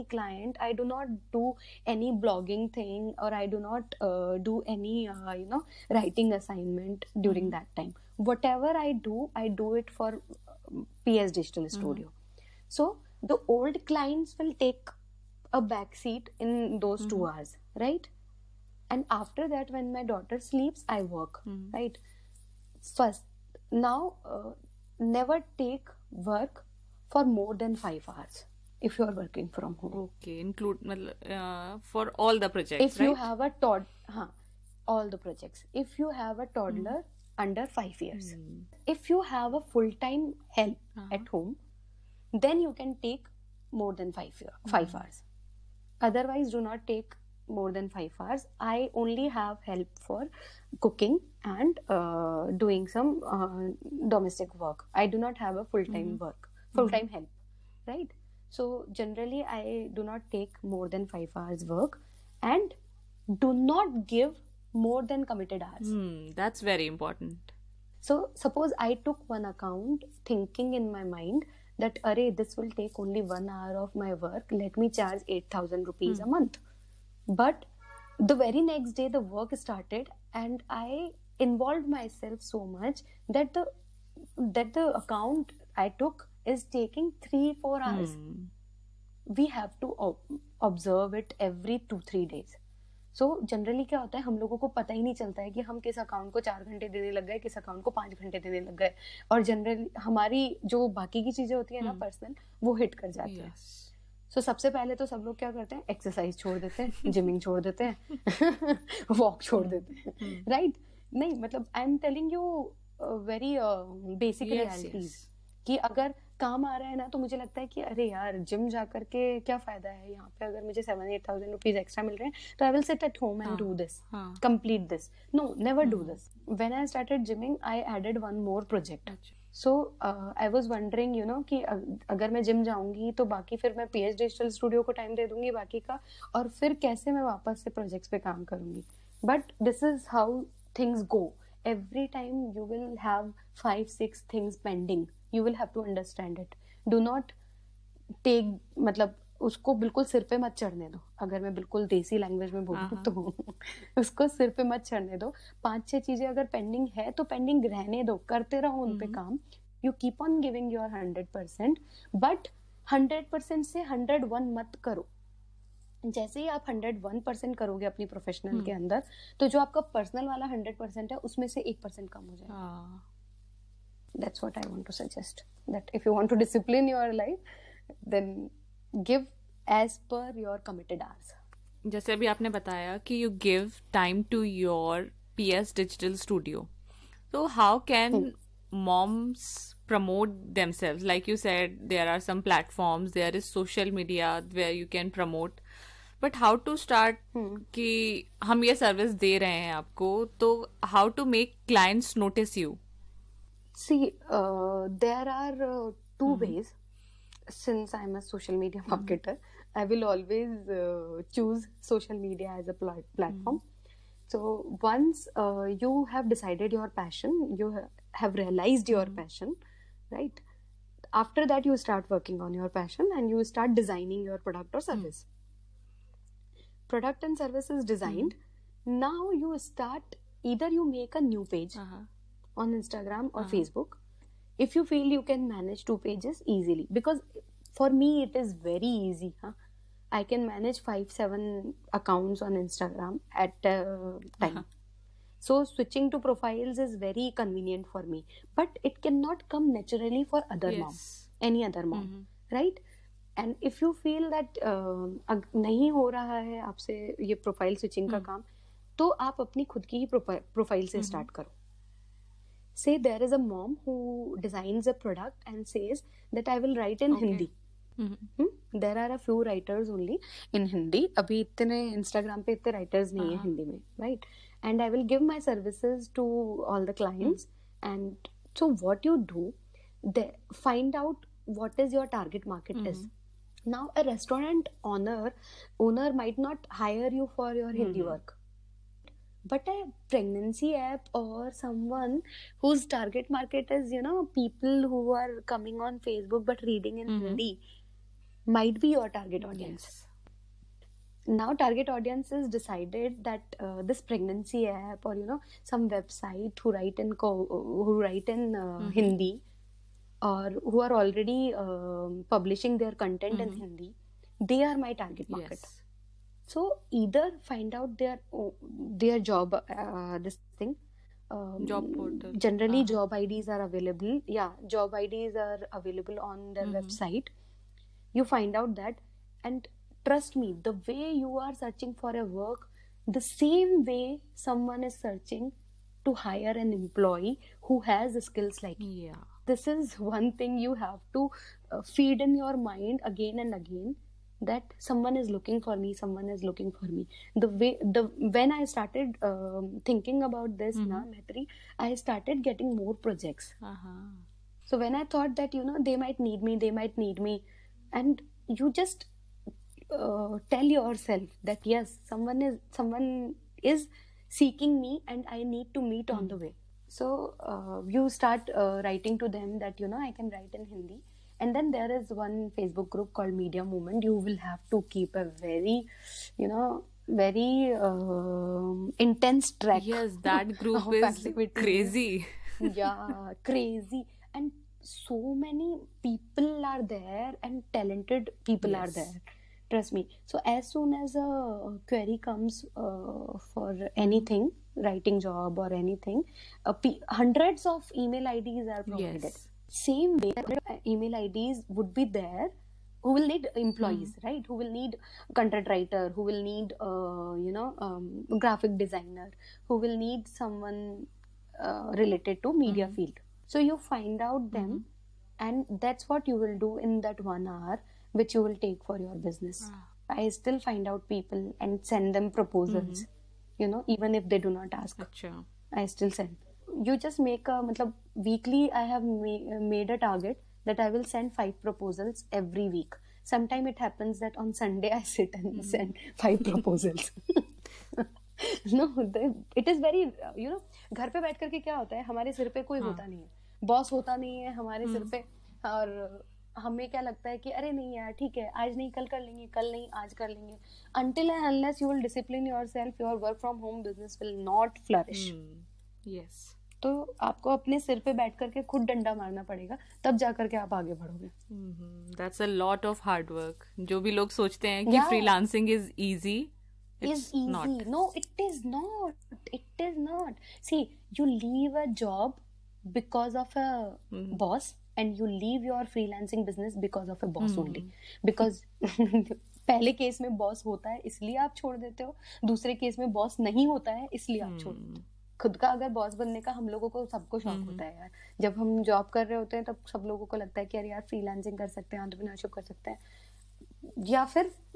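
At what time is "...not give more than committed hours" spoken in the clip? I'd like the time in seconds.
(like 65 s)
63 s.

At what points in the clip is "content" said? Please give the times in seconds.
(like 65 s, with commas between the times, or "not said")
312 s, 405 s.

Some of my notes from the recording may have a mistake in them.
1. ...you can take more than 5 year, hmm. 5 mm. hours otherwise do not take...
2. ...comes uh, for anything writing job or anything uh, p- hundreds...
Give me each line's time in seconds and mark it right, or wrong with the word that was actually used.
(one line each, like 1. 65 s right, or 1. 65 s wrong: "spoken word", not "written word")
1. 42 s right
2. 392 s right.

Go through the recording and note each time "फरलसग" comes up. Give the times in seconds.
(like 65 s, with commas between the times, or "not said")
465 s, 491 s.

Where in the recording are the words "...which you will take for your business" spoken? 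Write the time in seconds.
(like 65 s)
418 s.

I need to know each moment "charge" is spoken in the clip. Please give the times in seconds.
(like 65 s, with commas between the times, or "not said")
74 s.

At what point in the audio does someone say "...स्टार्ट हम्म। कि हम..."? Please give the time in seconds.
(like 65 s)
196 s.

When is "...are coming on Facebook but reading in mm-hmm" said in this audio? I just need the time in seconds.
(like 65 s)
295 s.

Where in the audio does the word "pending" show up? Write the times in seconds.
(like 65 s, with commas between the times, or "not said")
144 s.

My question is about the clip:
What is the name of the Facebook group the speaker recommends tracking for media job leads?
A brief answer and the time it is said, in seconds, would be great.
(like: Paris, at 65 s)
Media Movement, at 373 s.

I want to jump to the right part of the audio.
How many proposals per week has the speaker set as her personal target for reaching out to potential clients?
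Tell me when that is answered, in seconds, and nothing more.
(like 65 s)
431 s.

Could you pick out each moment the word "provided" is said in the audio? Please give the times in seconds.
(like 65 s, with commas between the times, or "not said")
398 s.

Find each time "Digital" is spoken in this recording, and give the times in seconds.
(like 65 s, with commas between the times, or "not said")
11 s.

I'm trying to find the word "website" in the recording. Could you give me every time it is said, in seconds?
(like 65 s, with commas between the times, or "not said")
305 s, 326 s.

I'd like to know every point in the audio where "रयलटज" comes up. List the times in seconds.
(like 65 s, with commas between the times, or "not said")
114 s.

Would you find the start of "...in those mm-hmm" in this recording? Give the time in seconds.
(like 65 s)
16 s.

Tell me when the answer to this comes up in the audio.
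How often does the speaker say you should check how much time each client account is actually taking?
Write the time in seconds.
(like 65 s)
91 s.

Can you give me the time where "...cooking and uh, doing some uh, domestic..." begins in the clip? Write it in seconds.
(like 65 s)
50 s.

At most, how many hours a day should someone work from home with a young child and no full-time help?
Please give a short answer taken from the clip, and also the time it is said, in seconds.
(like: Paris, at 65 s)
5, at 24 s.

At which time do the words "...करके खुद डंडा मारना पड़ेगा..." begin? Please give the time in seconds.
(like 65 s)
458 s.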